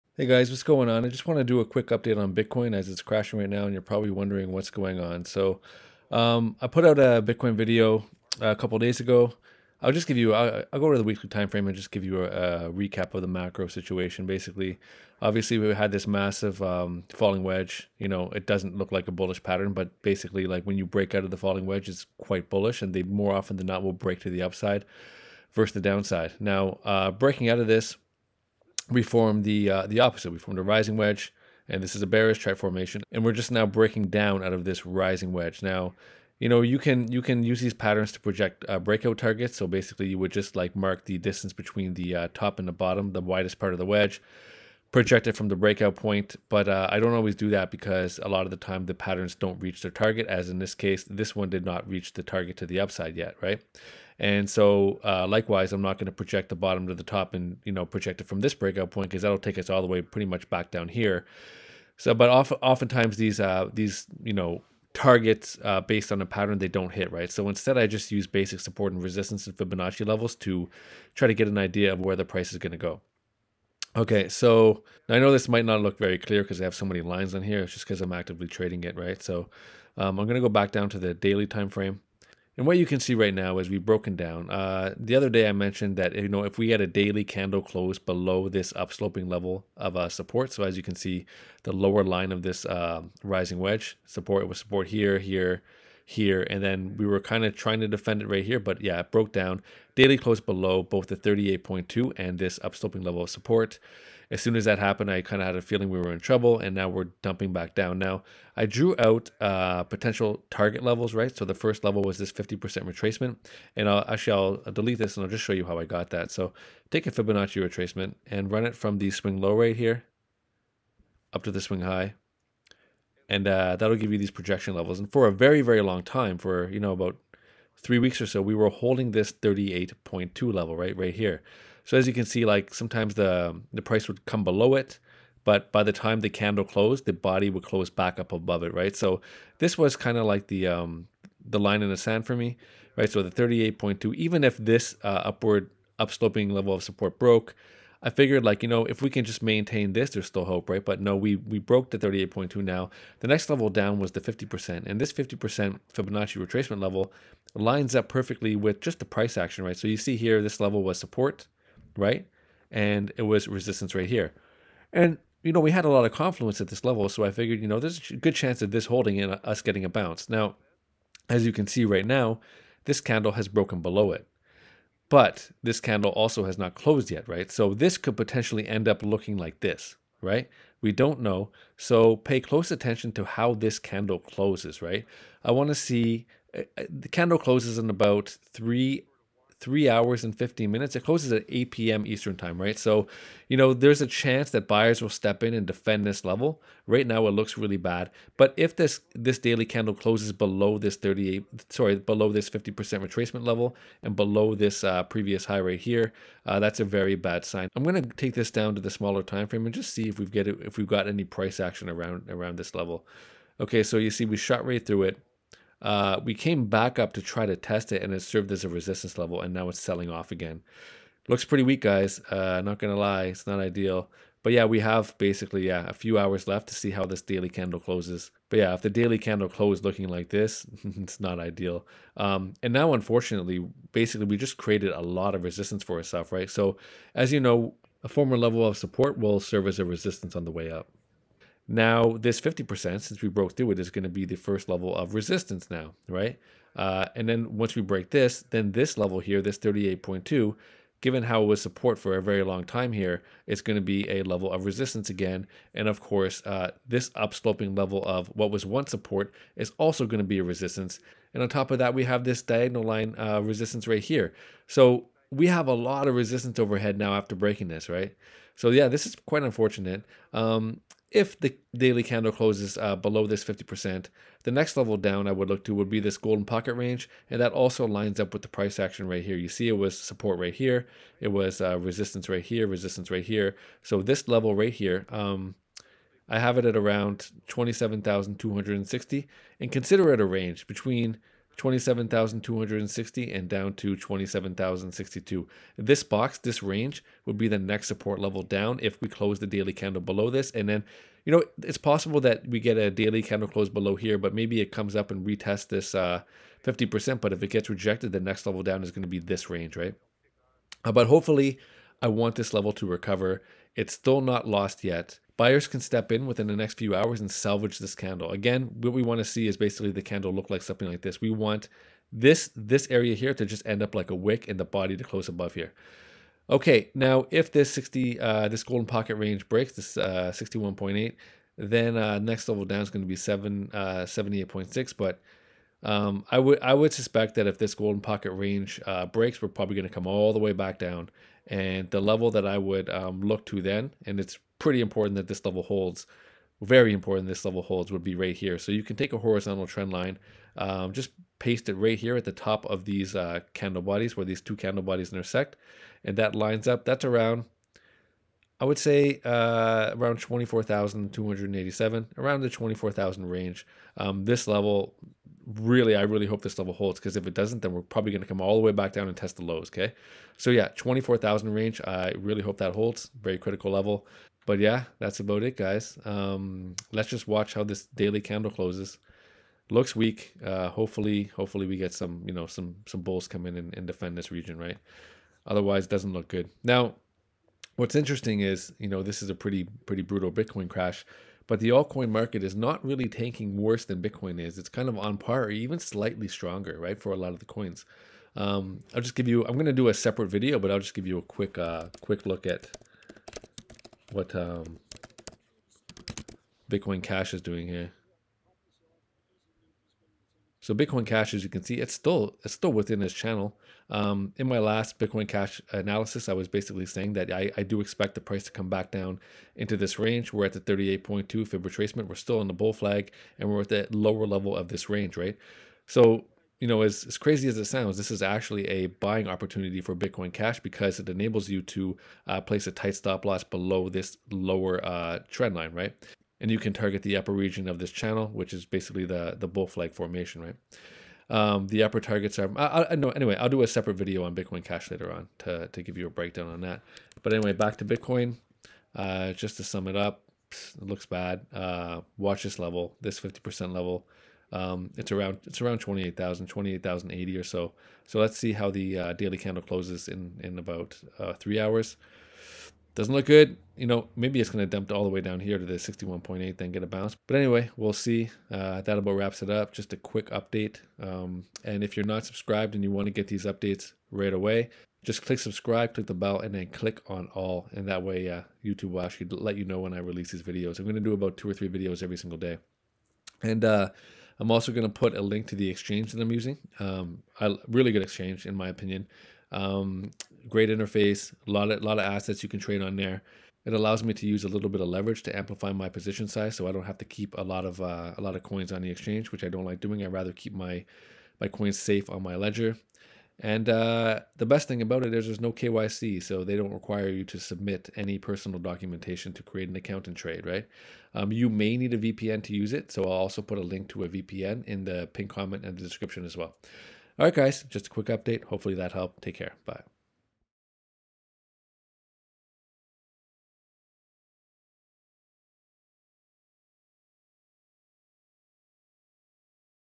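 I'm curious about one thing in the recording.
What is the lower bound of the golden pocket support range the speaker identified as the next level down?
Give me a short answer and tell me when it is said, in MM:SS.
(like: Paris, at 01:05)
27,062, at 04:53.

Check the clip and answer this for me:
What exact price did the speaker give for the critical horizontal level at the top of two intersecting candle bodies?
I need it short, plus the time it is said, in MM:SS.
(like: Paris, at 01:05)
24,287, at 06:00.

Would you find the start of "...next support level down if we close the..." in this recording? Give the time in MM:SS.
04:57.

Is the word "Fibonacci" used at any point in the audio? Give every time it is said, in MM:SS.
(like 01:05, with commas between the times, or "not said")
01:09, 01:57, 02:35.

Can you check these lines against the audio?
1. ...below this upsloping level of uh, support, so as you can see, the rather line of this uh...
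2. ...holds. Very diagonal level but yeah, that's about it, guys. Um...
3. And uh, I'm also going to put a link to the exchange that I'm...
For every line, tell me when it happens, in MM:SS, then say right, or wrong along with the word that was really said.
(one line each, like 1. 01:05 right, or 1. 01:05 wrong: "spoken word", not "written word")
1. 01:27 wrong: "lower", not "rather"
2. 06:12 wrong: "critical", not "diagonal"
3. 08:03 right.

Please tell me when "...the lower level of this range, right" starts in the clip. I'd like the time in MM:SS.
07:03.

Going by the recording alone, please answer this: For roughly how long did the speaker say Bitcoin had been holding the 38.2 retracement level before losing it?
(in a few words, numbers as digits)
About three weeks.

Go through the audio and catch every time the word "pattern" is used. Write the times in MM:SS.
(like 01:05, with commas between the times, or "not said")
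00:19, 00:37, 00:48, 01:06.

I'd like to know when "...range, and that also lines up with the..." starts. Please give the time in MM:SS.
04:36.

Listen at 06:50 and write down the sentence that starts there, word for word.
So Bitcoin Cash, as you can see, it's still it's still within this channel.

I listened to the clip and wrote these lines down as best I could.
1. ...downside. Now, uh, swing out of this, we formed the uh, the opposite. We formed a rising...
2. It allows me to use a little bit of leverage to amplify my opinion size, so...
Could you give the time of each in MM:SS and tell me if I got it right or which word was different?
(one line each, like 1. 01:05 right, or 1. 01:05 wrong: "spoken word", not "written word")
1. 00:25 wrong: "breaking", not "swing"
2. 08:13 wrong: "position", not "opinion".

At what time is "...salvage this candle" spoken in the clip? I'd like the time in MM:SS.
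05:17.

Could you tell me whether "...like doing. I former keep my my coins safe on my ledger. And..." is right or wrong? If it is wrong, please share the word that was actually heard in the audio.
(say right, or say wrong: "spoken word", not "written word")
wrong: "rather", not "former".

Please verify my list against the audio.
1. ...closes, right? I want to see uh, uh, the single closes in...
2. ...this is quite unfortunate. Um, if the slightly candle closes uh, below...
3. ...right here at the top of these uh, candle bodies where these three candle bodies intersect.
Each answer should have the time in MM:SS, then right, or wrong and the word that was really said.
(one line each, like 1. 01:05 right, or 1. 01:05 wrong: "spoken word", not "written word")
1. 03:04 wrong: "candle", not "single"
2. 04:28 wrong: "daily", not "slightly"
3. 05:51 wrong: "two", not "three".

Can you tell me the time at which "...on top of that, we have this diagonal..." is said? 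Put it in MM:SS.
04:21.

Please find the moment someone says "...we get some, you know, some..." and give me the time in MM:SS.
06:21.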